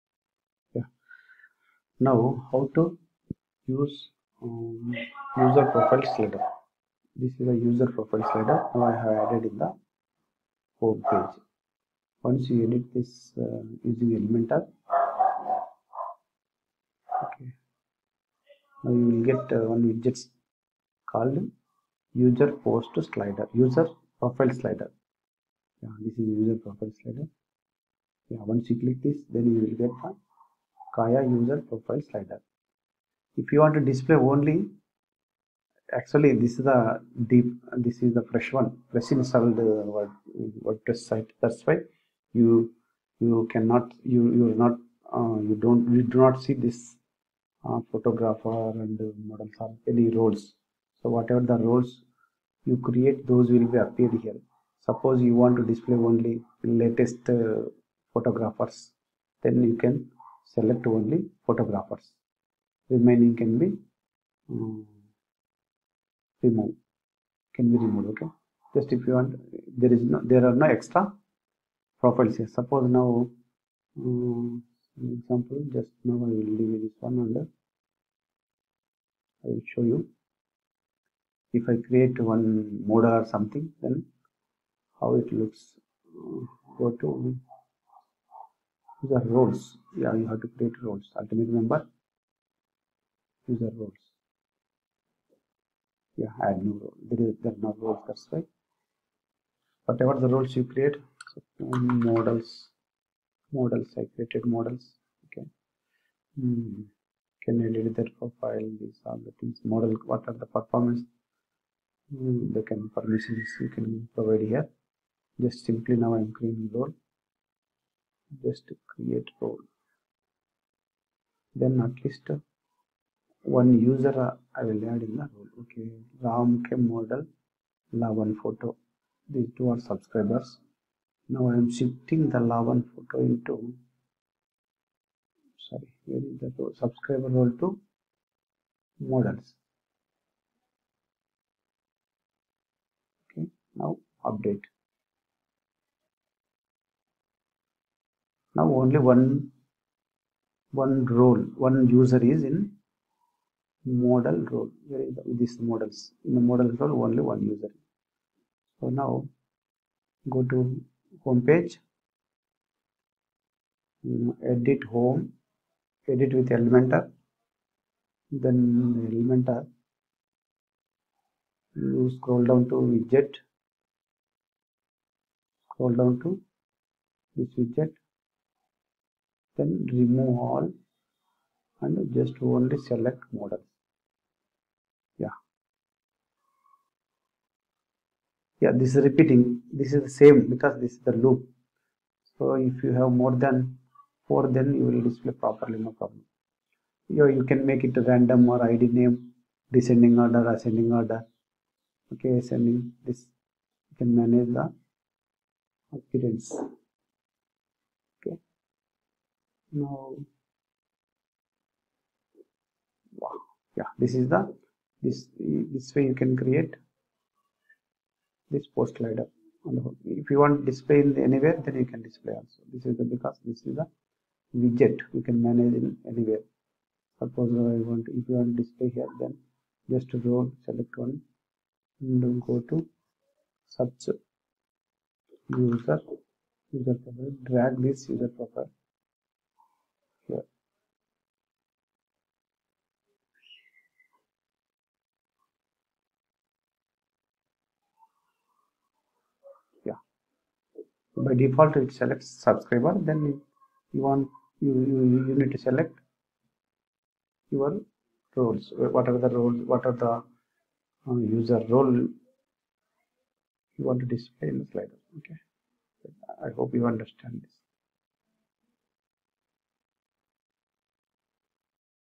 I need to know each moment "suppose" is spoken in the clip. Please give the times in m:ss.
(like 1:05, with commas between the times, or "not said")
0:54, 1:12, 3:47.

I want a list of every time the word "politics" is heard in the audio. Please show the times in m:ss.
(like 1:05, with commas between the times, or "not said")
not said.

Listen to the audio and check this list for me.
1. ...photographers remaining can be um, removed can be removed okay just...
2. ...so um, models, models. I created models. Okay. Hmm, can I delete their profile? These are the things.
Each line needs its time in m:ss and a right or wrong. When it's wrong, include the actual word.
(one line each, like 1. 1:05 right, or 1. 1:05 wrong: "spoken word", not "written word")
1. 1:01 right
2. 1:41 right.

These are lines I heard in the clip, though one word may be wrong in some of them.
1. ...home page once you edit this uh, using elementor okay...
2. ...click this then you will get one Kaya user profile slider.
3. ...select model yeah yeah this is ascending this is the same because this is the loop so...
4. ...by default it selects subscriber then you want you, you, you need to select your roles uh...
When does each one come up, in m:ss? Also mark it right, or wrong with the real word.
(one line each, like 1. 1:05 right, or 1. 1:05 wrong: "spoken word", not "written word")
1. 0:10 right
2. 0:28 right
3. 3:02 wrong: "repeating", not "ascending"
4. 4:11 right.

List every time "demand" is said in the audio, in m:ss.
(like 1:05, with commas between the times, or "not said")
not said.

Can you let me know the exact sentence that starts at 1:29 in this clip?
Yeah, you have to create roles.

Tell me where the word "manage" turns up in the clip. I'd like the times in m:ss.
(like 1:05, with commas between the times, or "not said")
3:24, 3:45.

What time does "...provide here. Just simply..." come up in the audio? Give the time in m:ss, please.
1:54.